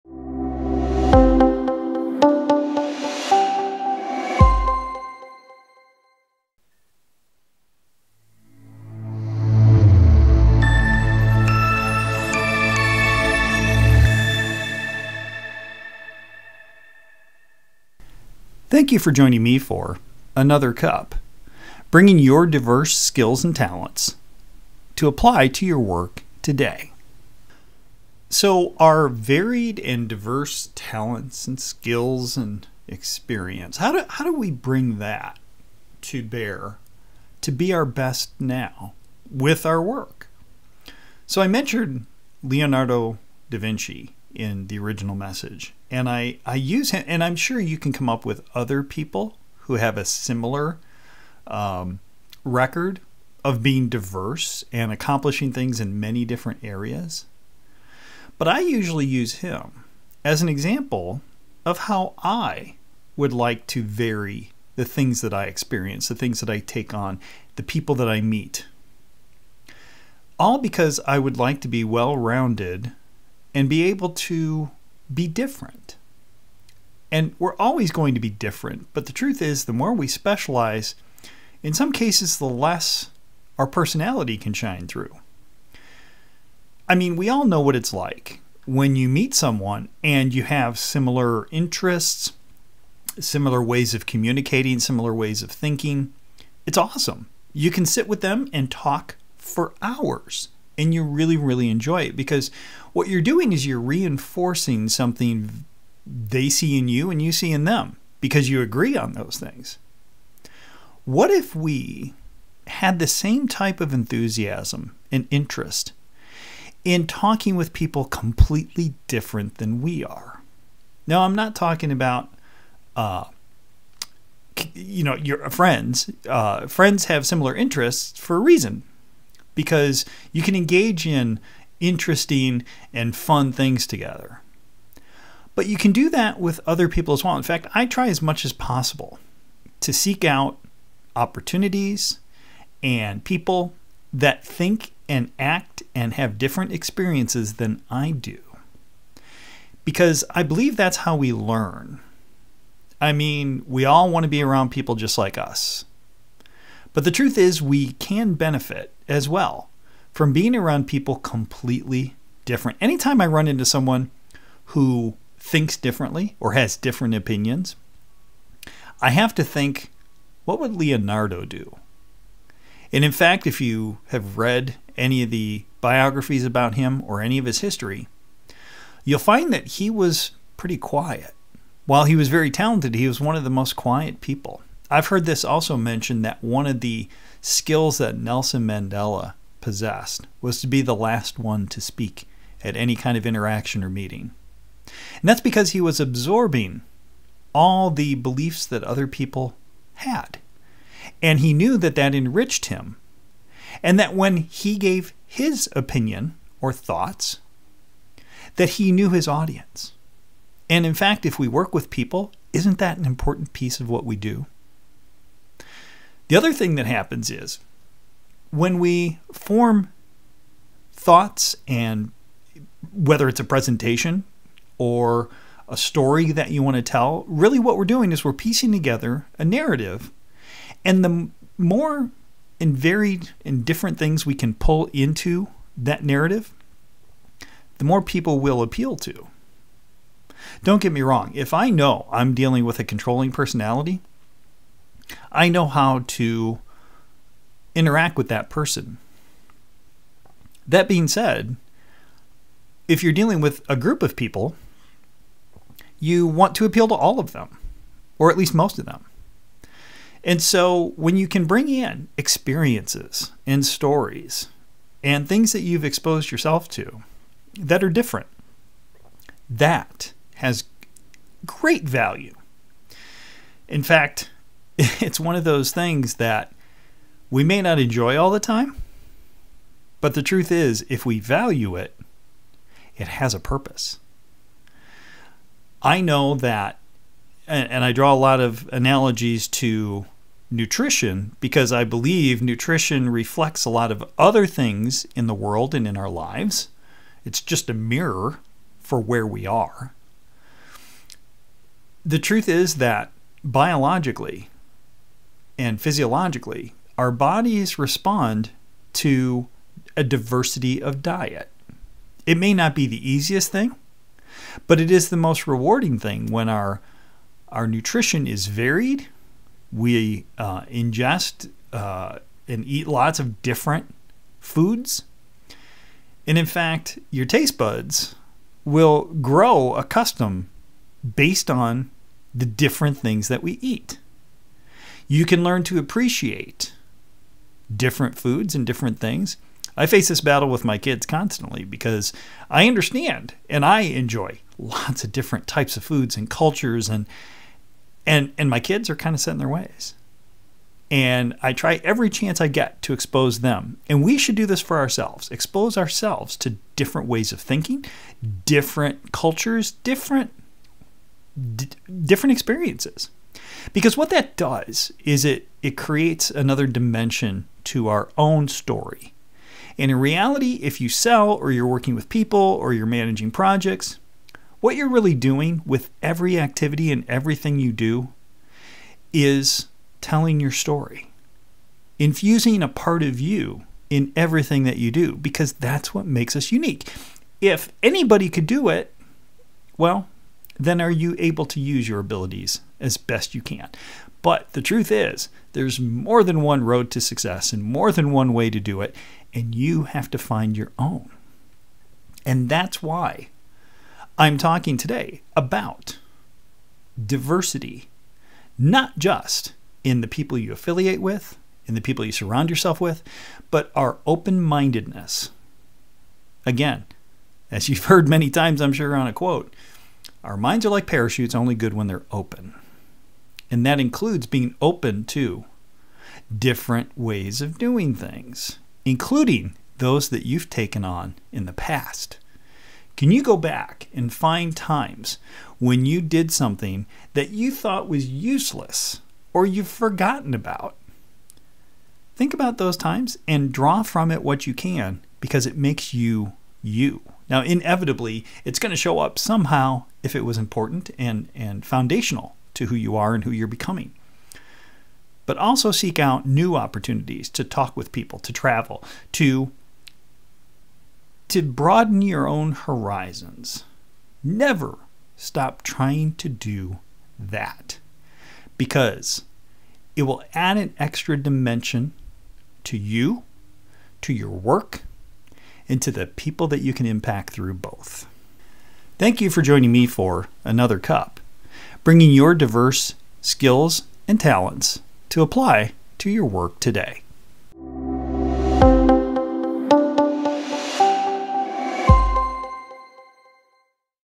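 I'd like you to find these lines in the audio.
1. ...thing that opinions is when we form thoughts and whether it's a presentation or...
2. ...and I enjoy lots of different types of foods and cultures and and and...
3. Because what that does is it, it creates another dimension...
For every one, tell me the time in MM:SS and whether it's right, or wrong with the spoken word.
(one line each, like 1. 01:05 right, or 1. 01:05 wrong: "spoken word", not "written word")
1. 03:36 wrong: "happens", not "opinions"
2. 05:43 right
3. 06:03 right.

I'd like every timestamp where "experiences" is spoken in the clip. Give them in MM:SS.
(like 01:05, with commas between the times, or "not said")
00:32, 01:05, 02:26, 04:22, 06:02.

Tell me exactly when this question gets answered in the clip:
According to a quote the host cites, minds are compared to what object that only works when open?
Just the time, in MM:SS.
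07:00.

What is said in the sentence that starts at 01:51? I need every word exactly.
What if we had the same type of enthusiasm and interest in talking with people completely different than we are?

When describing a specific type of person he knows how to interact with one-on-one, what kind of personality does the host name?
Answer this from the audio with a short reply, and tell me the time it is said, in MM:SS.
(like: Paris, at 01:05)
controlling personality, at 04:02.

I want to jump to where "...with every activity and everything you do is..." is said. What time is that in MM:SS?
06:15.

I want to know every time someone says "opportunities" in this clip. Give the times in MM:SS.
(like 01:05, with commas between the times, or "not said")
02:21, 07:36.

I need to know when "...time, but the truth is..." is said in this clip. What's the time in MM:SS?
04:38.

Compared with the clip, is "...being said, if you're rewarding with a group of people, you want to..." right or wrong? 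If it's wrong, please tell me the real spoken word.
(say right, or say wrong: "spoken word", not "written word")
wrong: "dealing", not "rewarding".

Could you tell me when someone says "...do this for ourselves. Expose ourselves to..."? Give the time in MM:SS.
05:54.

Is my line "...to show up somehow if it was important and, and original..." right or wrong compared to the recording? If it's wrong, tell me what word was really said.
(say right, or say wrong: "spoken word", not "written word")
wrong: "foundational", not "original".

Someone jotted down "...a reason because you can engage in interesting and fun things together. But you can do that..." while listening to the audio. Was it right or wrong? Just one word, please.
right.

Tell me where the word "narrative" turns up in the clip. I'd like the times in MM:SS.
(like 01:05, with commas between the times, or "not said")
03:49, 03:56.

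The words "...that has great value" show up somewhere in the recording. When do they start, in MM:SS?
04:29.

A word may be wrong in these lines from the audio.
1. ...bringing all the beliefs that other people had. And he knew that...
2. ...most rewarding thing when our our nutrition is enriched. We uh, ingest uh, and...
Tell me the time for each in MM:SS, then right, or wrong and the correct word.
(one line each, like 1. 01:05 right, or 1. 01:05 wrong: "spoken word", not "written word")
1. 03:16 wrong: "absorbing", not "bringing"
2. 05:15 wrong: "varied", not "enriched".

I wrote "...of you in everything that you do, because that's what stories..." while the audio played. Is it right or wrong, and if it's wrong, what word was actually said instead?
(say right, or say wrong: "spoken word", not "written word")
wrong: "makes", not "stories".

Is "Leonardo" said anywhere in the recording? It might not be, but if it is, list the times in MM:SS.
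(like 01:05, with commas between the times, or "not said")
00:42, 02:50.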